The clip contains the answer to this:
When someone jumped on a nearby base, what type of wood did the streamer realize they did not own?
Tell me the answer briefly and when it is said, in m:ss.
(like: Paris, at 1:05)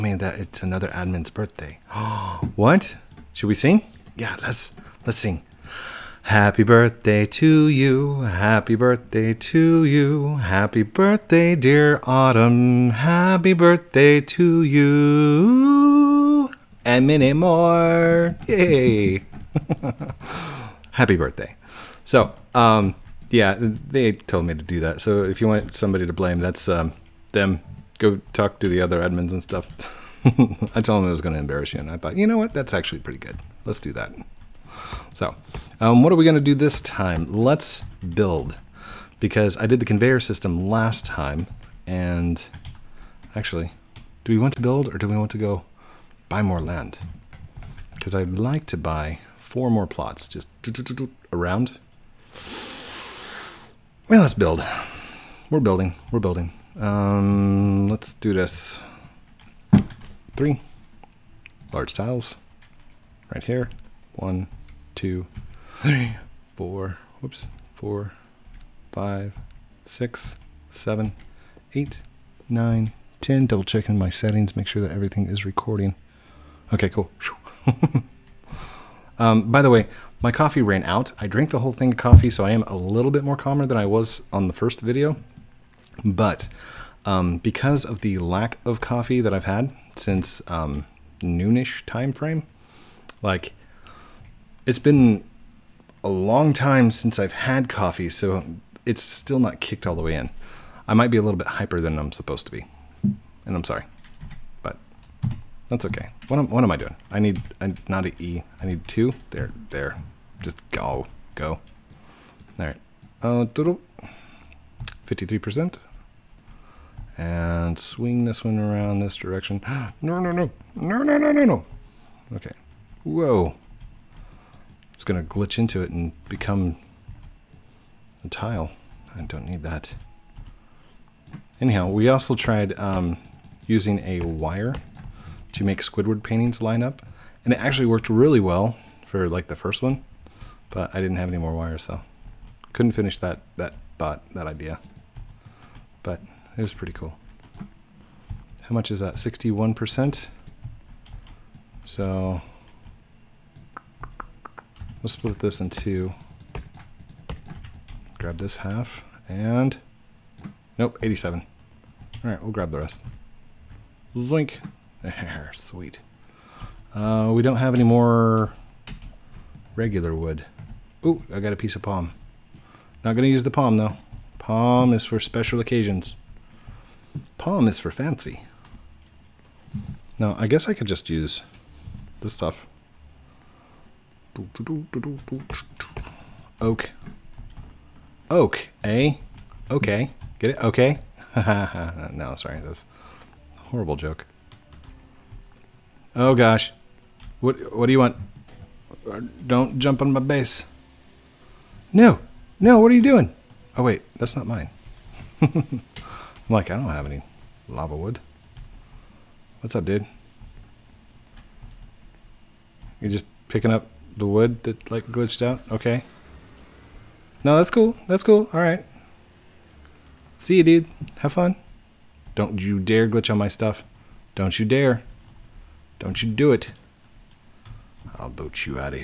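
Lava wood, at 3:27.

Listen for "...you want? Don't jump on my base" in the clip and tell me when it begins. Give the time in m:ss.
3:17.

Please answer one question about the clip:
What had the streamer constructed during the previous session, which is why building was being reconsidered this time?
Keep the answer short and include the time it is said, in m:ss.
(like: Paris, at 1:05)
Conveyor system, at 0:39.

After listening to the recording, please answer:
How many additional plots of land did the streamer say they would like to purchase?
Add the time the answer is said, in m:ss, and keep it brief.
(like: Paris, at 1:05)
4, at 0:49.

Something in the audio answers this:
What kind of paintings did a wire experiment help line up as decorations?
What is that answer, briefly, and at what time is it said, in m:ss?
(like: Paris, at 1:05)
Squidward paintings, at 2:15.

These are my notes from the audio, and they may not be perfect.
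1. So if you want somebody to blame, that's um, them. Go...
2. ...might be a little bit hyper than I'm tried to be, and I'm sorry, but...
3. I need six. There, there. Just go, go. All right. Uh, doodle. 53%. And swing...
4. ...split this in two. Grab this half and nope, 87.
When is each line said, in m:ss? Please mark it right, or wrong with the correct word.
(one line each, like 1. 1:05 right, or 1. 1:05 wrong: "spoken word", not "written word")
1. 0:24 right
2. 1:40 wrong: "supposed", not "tried"
3. 1:48 wrong: "two", not "six"
4. 2:35 right.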